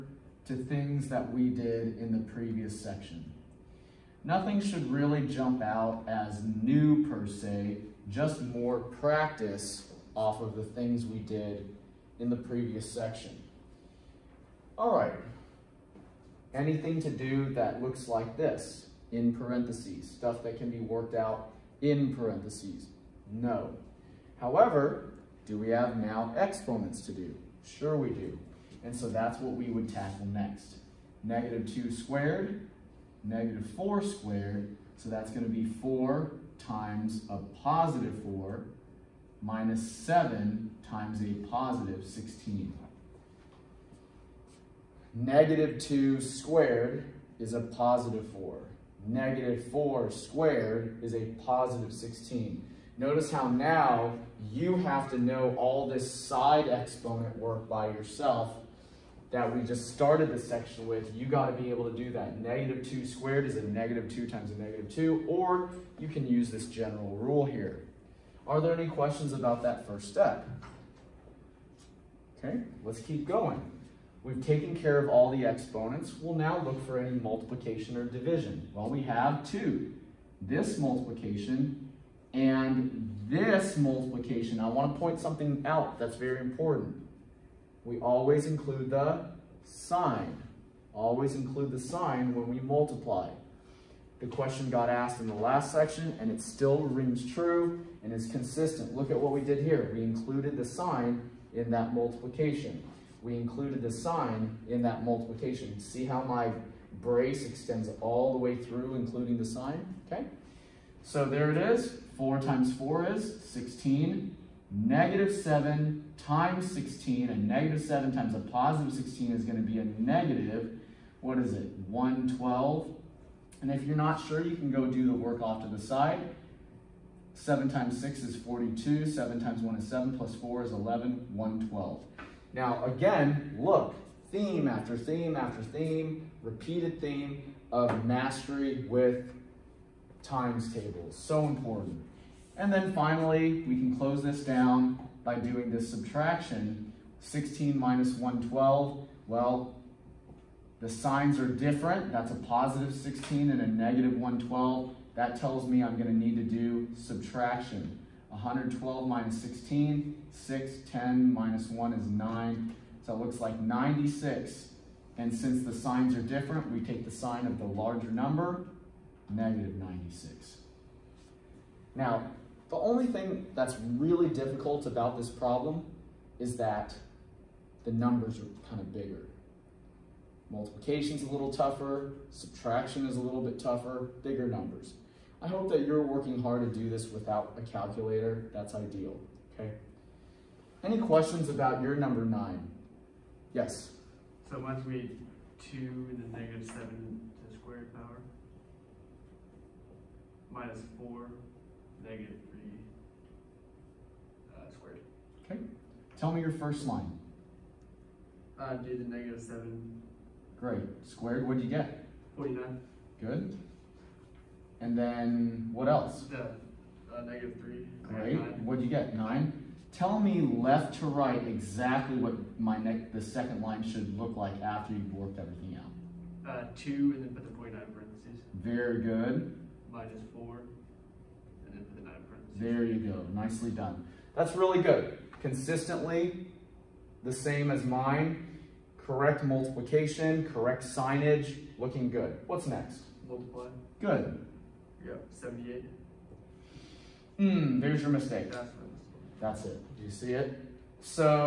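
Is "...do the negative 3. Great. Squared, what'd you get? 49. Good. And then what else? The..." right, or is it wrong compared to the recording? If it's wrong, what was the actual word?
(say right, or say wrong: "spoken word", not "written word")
wrong: "7", not "3".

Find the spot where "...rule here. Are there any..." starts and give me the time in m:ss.
1:07.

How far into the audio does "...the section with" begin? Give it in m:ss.
1:00.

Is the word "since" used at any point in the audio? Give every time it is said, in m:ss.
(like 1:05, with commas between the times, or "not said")
2:45.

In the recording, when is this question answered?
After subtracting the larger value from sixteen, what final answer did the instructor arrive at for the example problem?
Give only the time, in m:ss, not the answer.
2:49.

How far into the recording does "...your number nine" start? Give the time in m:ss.
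3:11.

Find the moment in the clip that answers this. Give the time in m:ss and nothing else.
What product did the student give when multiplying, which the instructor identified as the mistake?
4:05.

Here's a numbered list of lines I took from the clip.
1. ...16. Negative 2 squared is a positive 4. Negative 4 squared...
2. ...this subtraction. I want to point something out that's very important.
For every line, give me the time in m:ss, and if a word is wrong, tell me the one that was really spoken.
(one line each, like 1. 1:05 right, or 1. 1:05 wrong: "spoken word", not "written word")
1. 0:42 right
2. 1:23 wrong: "multiplication", not "subtraction".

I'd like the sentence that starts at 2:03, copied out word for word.
And if you're not sure, you can go do the work off to the side.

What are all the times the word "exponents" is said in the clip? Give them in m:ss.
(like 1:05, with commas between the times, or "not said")
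0:26, 0:56, 1:15.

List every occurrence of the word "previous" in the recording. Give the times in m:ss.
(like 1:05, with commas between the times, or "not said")
0:02, 0:12.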